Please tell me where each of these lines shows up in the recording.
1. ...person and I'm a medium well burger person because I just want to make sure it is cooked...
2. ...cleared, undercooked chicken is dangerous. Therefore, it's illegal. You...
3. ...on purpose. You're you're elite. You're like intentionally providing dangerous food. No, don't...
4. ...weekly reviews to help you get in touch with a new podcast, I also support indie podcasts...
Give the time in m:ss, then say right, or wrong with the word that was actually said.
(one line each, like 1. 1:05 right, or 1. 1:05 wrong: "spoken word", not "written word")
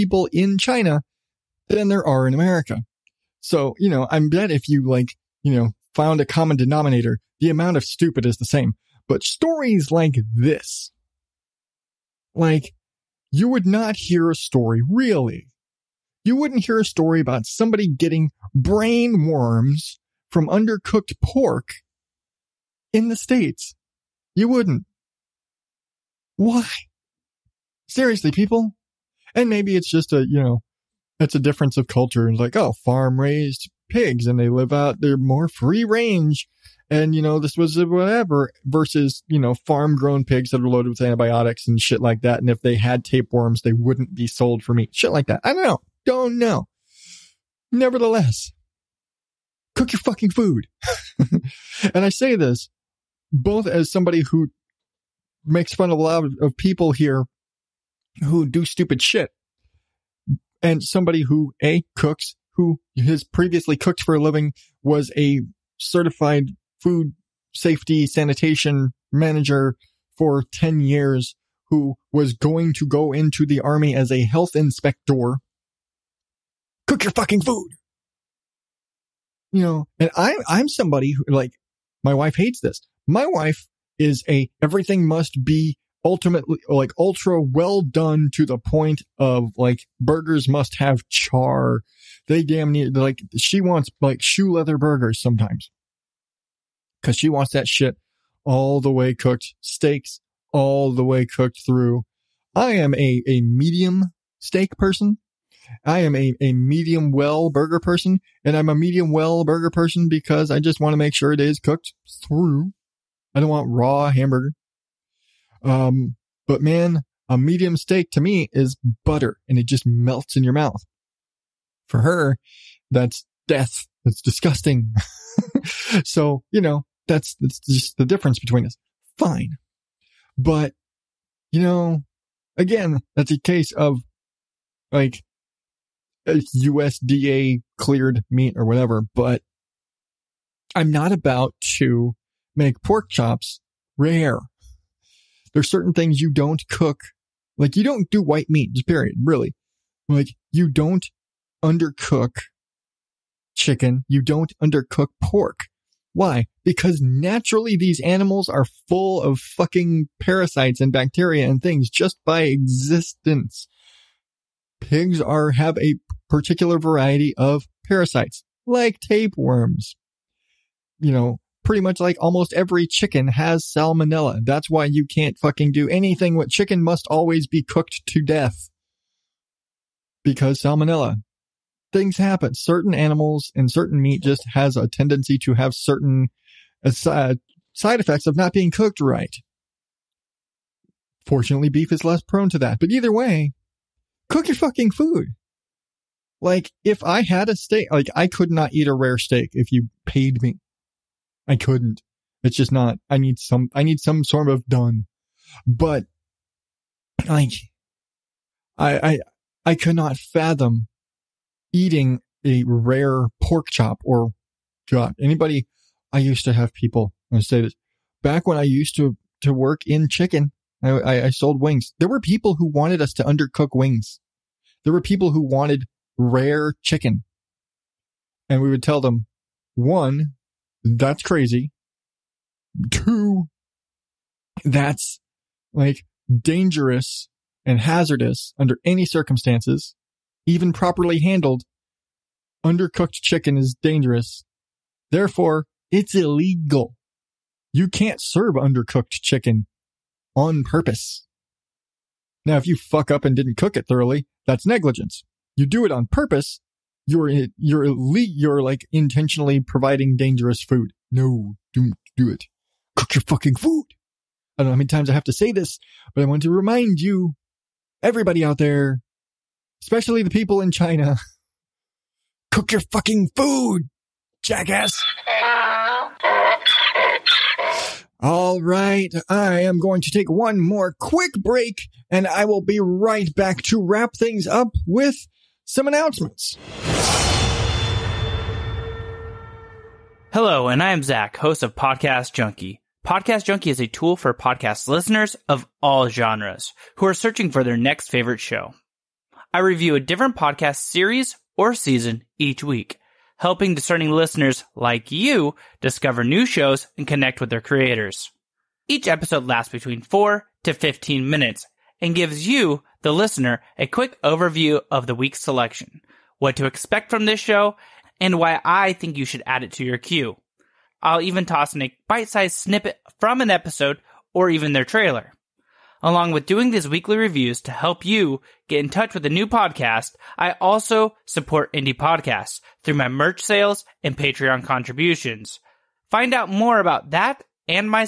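1. 1:47 right
2. 4:01 wrong: "handled", not "cleared"
3. 4:15 right
4. 5:26 right.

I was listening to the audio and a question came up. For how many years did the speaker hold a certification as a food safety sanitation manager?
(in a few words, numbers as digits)
10.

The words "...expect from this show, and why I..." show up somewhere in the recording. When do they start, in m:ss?
5:16.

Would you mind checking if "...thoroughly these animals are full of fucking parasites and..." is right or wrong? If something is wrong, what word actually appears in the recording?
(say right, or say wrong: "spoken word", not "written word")
wrong: "naturally", not "thoroughly".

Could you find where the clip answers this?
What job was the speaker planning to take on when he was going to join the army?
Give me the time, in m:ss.
1:14.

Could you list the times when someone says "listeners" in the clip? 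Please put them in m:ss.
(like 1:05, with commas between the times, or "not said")
4:54, 5:04, 5:13.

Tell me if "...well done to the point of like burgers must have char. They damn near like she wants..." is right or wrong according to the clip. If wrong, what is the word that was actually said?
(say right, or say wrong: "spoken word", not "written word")
right.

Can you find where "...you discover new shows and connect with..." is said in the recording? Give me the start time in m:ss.
5:05.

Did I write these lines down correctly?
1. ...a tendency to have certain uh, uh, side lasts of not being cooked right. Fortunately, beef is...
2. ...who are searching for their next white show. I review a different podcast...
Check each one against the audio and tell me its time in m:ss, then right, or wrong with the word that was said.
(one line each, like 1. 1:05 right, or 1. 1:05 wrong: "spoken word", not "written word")
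1. 3:04 wrong: "effects", not "lasts"
2. 4:56 wrong: "favorite", not "white".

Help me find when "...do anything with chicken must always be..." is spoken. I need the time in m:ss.
2:55.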